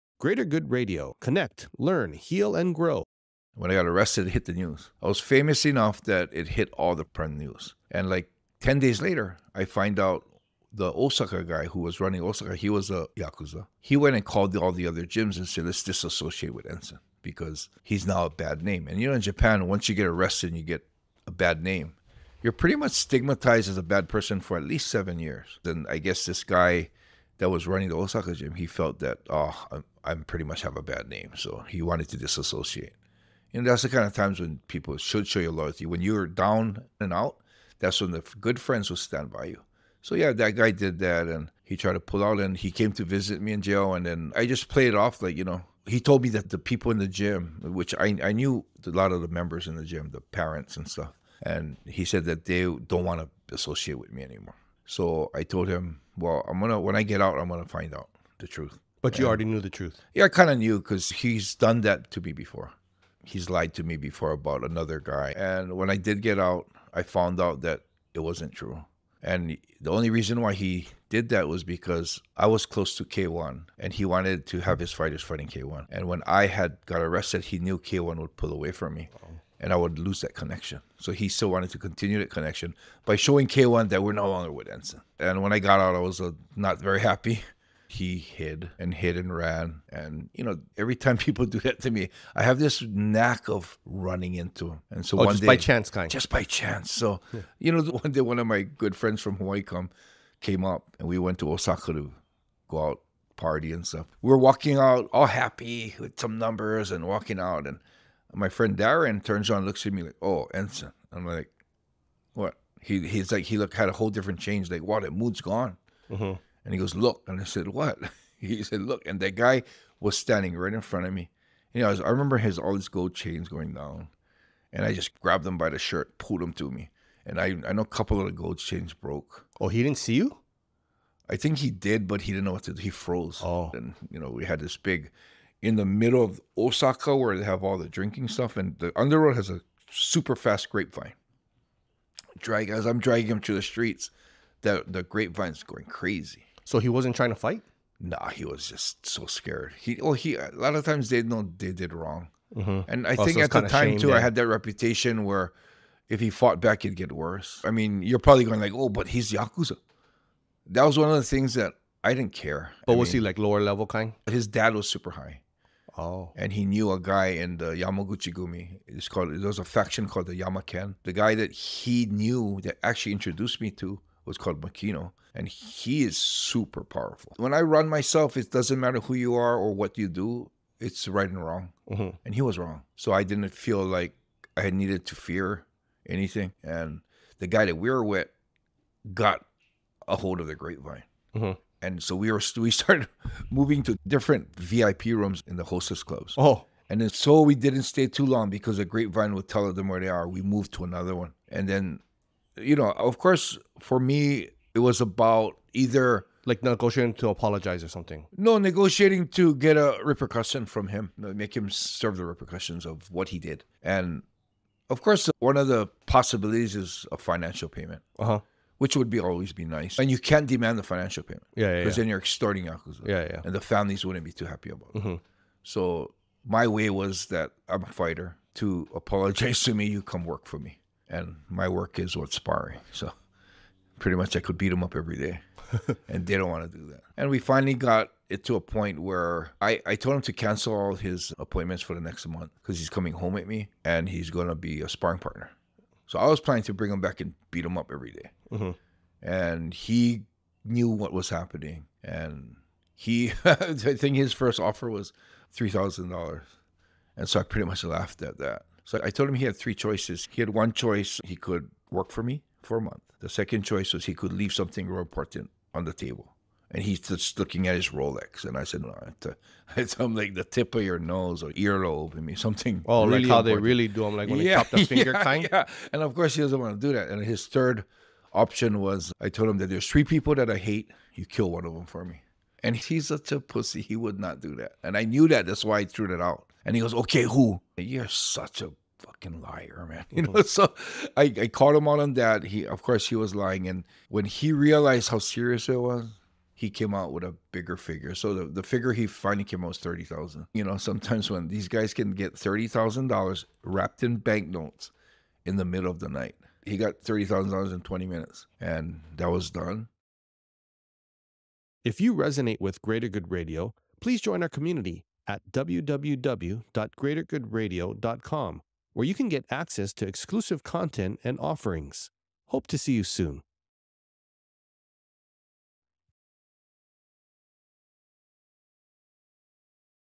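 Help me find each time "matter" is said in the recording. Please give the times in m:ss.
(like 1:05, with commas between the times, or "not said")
2:58.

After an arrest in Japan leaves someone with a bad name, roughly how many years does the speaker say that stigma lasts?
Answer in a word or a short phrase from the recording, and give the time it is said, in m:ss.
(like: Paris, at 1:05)
7 years, at 0:24.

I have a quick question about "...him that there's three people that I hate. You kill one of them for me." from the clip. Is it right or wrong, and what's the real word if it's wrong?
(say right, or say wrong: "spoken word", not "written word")
right.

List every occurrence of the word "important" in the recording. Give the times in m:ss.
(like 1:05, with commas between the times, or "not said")
4:24, 4:33.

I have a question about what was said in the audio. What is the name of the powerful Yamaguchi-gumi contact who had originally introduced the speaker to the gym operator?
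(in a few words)
Makino.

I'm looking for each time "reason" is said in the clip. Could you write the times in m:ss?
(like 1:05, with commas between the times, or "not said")
1:10.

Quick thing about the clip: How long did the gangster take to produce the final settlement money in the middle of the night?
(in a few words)
20 minutes.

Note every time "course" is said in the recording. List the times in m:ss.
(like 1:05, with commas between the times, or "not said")
3:23, 3:35, 4:36, 4:52.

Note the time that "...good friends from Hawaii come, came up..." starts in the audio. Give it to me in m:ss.
1:38.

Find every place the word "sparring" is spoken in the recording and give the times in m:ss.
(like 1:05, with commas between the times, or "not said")
3:52, 4:04.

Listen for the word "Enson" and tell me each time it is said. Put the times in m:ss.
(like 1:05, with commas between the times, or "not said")
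0:16, 1:24, 1:50.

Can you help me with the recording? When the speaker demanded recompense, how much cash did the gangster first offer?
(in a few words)
$3,000.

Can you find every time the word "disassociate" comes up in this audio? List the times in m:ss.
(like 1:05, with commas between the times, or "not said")
0:15, 0:32.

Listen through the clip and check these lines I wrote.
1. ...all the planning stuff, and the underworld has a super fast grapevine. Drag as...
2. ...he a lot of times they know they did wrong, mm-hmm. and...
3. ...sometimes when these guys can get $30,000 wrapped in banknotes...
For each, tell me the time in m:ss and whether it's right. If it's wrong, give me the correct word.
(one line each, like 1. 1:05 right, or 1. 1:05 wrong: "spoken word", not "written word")
1. 2:17 wrong: "drinking", not "planning"
2. 2:30 right
3. 5:00 right.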